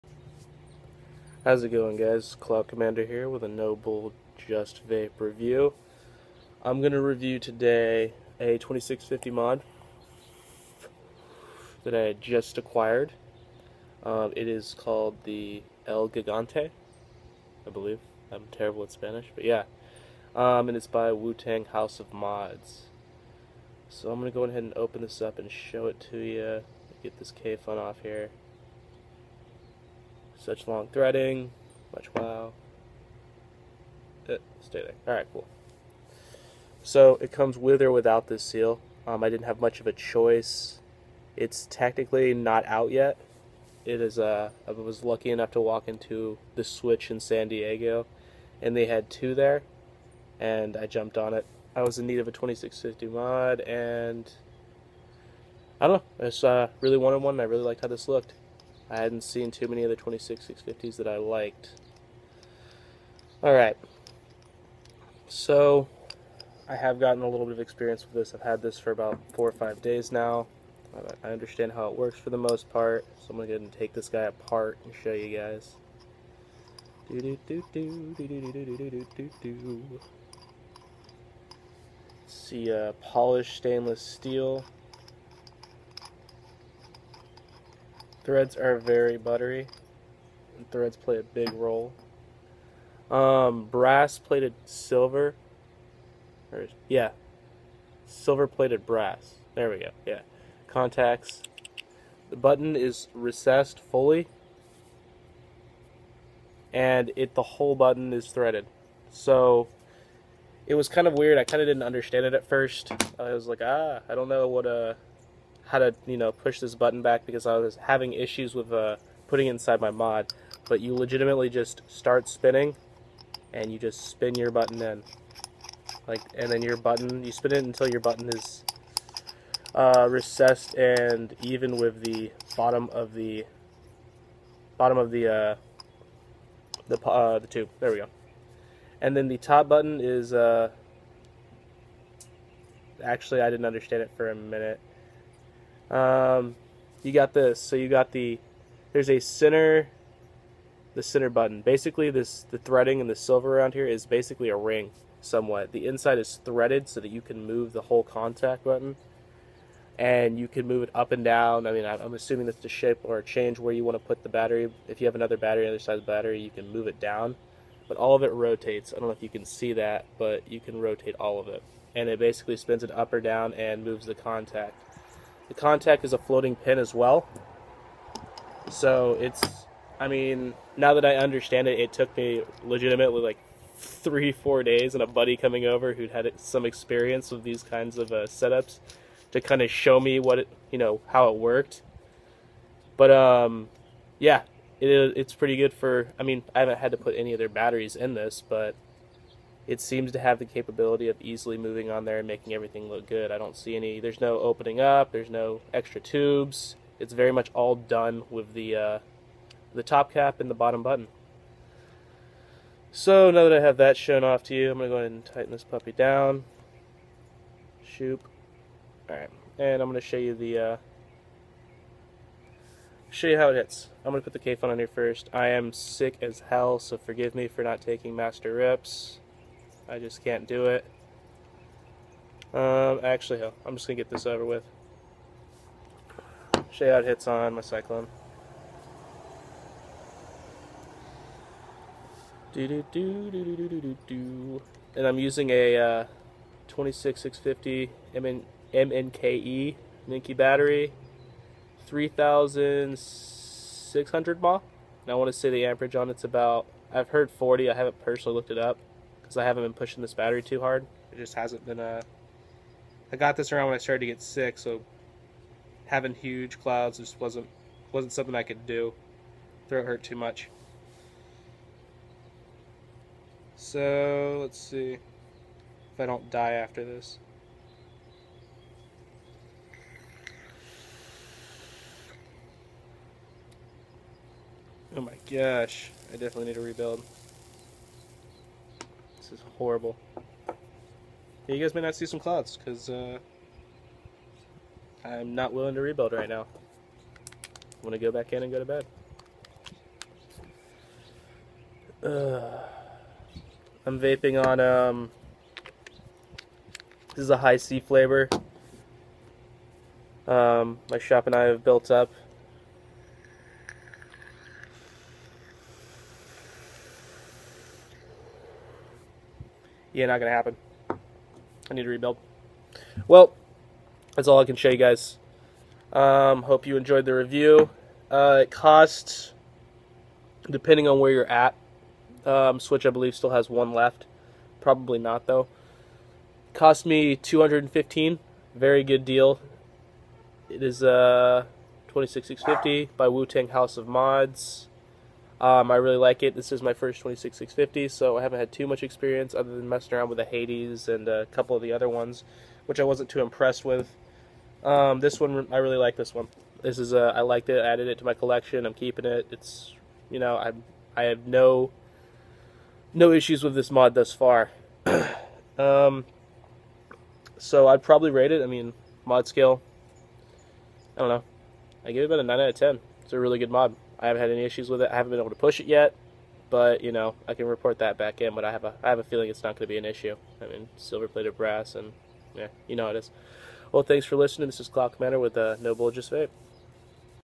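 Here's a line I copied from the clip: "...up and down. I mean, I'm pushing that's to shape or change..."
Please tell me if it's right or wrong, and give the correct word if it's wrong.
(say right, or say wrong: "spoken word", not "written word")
wrong: "assuming", not "pushing".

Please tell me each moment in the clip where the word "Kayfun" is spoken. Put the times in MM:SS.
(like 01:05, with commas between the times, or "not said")
00:27, 03:44.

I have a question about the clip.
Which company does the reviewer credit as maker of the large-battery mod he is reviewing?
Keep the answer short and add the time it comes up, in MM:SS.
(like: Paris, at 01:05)
Wu-Tang House of Mods, at 00:21.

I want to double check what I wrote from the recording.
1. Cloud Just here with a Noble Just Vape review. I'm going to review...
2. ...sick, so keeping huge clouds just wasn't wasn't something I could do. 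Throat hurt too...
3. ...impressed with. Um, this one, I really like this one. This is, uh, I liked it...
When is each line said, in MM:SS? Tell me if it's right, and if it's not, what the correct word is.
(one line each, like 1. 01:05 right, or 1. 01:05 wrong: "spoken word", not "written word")
1. 00:02 wrong: "Commander", not "Just"
2. 04:24 wrong: "having", not "keeping"
3. 05:53 right.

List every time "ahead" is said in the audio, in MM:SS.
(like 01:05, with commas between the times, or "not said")
00:24, 03:34.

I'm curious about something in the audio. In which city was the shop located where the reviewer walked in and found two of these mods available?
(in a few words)
San Diego.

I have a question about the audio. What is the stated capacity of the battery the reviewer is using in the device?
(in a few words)
3,600 mAh.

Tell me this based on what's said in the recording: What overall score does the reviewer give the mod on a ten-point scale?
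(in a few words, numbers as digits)
9 out of 10.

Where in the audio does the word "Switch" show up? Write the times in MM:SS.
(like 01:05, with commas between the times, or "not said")
00:46, 05:32.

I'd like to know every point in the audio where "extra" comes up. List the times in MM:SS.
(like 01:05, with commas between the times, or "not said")
03:25.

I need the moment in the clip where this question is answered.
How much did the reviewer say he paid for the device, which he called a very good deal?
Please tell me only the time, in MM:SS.
05:37.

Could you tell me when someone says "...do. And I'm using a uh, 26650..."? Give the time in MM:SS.
04:04.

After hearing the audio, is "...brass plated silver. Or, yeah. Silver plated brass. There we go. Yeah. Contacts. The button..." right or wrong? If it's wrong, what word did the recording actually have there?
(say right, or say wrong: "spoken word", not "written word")
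right.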